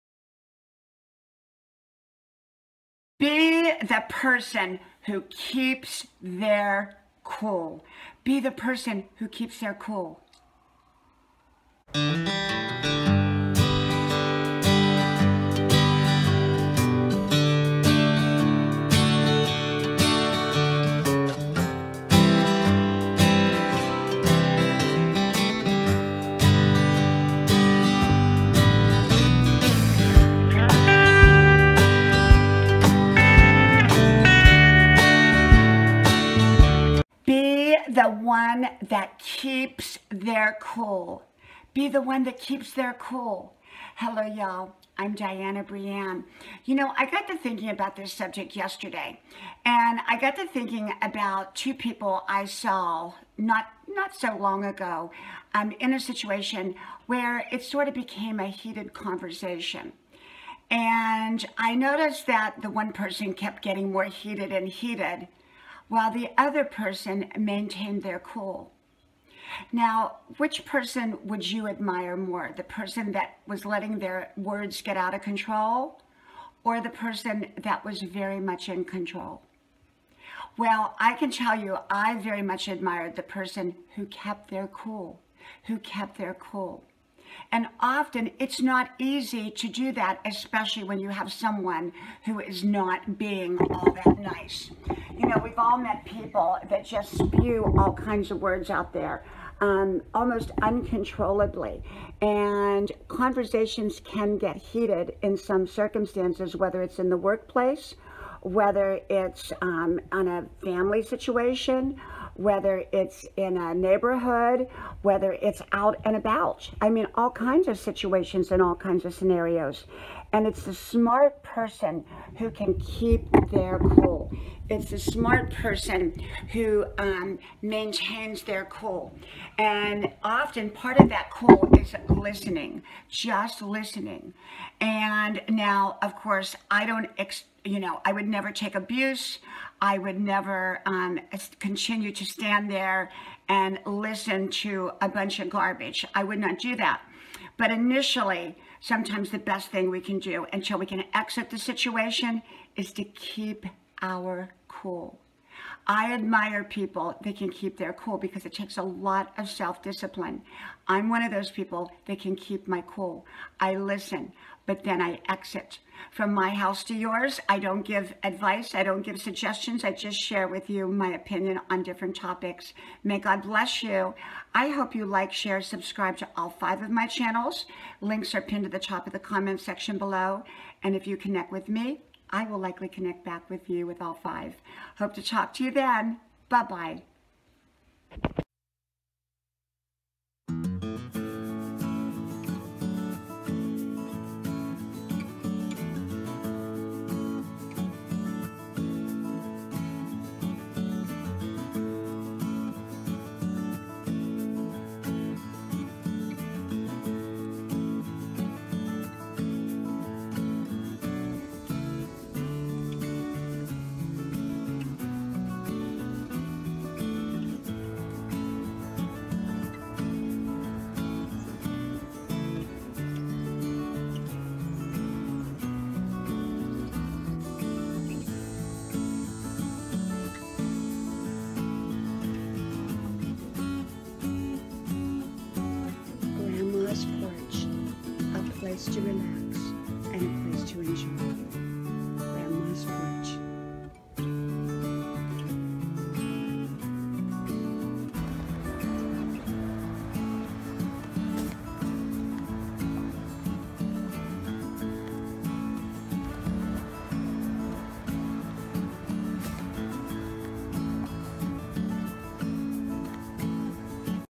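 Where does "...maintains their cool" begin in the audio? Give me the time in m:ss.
2:07.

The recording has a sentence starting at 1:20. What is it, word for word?
Well, I can tell you, I very much admired the person who kept their cool, who kept their cool.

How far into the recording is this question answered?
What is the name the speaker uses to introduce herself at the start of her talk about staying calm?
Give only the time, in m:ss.
0:45.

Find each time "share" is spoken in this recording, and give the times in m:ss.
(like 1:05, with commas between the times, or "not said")
2:50, 2:55.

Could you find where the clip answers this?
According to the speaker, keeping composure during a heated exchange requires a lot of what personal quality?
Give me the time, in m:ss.
2:39.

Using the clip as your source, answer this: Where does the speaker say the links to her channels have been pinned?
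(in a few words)
top of the comment section.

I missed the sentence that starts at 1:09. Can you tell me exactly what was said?
Now, which person would you admire more?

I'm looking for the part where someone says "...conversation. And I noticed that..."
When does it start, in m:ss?
0:58.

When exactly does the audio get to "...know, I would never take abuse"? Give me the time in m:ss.
2:17.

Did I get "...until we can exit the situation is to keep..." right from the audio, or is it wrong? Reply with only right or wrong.
right.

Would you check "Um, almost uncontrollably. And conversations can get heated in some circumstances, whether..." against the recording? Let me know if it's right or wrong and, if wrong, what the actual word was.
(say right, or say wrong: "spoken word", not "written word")
right.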